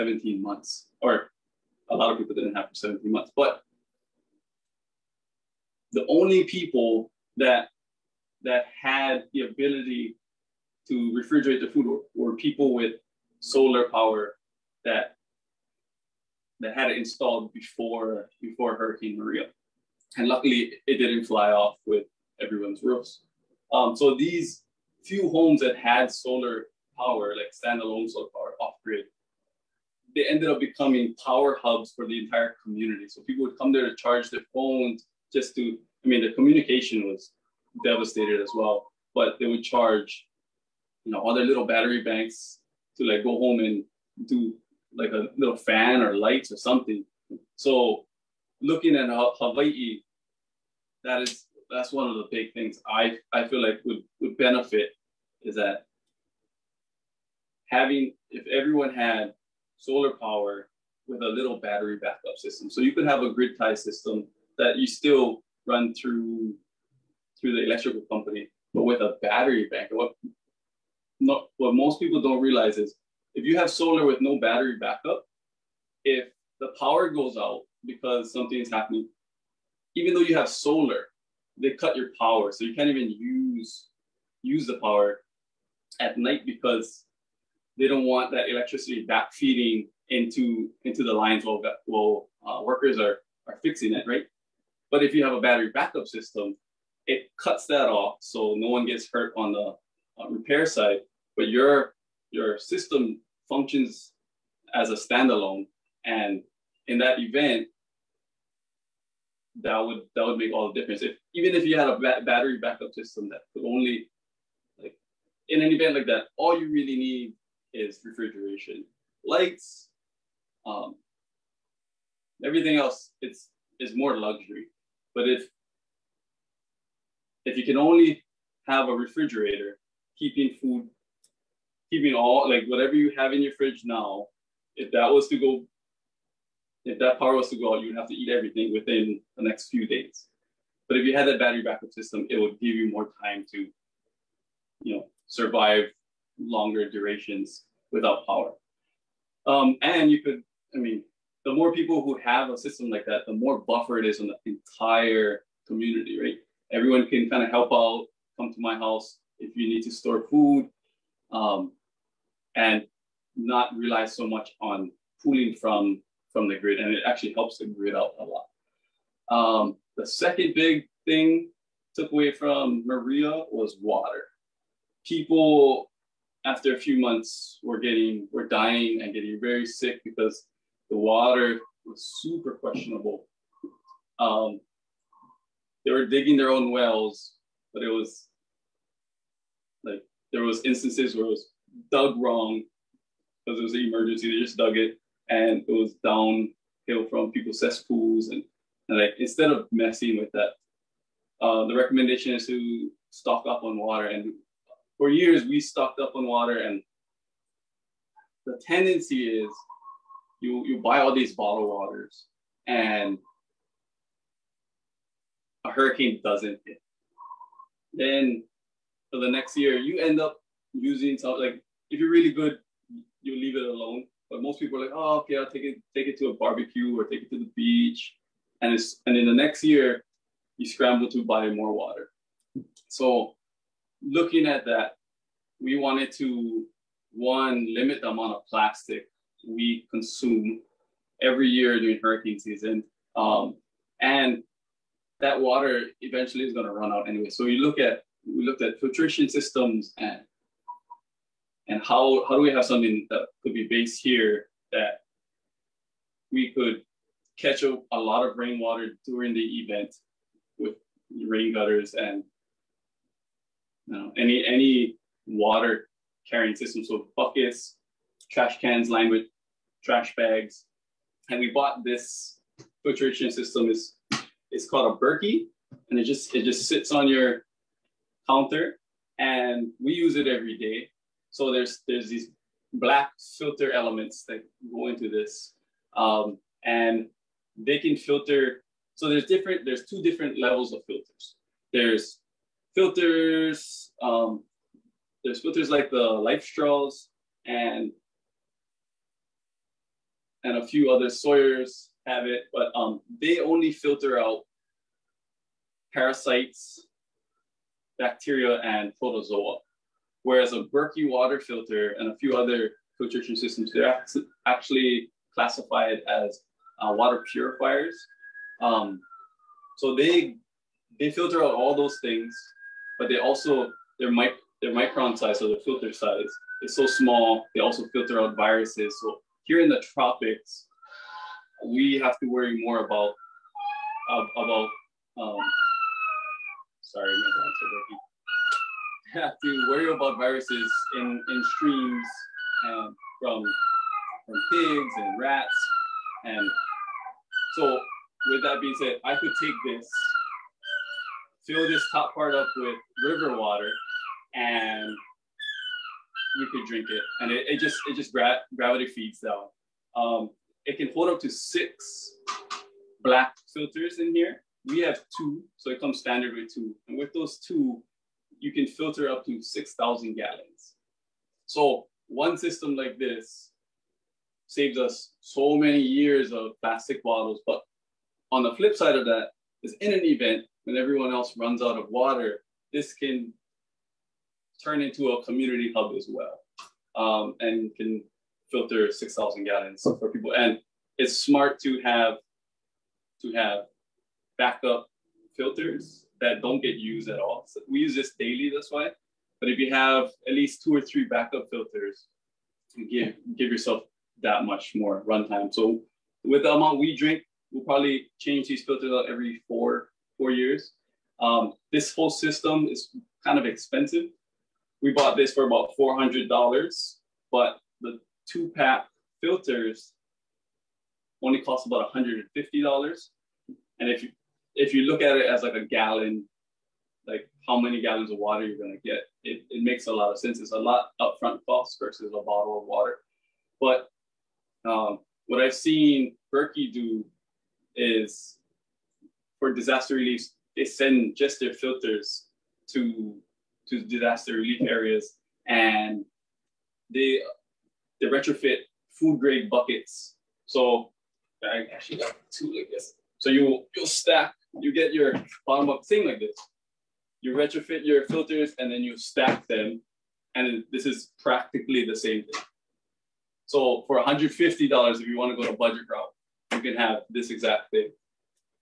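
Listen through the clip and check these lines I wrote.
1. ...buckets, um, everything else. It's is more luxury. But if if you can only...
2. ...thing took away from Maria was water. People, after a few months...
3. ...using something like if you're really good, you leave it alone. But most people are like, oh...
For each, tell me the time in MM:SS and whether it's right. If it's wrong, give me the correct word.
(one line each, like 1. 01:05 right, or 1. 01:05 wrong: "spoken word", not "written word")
1. 01:59 wrong: "lights", not "buckets"
2. 02:51 right
3. 03:40 right.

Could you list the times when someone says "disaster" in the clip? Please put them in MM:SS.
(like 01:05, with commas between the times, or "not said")
07:19, 07:23.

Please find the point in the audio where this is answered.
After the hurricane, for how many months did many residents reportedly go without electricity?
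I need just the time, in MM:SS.
00:02.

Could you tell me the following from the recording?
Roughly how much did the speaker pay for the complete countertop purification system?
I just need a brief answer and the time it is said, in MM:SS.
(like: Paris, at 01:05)
$400, at 06:55.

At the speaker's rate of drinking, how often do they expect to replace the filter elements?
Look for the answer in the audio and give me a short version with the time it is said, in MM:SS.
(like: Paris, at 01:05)
Every 4 years, at 06:49.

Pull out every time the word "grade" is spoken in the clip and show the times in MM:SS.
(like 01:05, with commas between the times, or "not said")
07:29.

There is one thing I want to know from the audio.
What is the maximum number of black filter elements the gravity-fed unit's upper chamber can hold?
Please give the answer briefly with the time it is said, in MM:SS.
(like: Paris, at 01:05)
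6, at 06:01.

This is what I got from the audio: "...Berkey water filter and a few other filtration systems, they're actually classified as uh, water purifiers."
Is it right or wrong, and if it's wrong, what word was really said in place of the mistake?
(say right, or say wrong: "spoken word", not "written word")
right.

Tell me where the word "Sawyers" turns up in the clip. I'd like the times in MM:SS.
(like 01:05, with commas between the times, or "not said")
05:01.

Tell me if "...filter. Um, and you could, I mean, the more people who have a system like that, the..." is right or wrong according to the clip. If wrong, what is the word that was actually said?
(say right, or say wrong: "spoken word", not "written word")
wrong: "power", not "filter".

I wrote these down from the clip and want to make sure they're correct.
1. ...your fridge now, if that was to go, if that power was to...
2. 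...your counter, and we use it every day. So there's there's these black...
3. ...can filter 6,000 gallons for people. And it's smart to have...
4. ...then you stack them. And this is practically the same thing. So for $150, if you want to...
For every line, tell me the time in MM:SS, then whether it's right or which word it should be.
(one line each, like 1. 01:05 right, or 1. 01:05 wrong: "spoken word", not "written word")
1. 02:13 right
2. 04:37 right
3. 06:27 right
4. 07:38 right.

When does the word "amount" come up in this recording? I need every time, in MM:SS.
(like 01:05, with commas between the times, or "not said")
03:58, 06:46.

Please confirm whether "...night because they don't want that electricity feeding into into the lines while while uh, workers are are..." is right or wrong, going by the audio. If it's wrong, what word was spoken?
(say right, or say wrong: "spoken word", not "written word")
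right.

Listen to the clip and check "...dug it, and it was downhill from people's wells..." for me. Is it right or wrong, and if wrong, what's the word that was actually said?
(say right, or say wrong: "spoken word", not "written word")
wrong: "cesspools", not "wells".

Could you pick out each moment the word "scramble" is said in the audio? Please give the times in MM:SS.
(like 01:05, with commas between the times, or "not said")
03:50.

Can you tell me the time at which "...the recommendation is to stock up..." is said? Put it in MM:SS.
03:21.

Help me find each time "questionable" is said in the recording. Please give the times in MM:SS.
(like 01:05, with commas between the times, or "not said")
03:02.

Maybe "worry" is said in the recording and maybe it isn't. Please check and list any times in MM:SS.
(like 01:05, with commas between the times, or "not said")
05:32, 05:39.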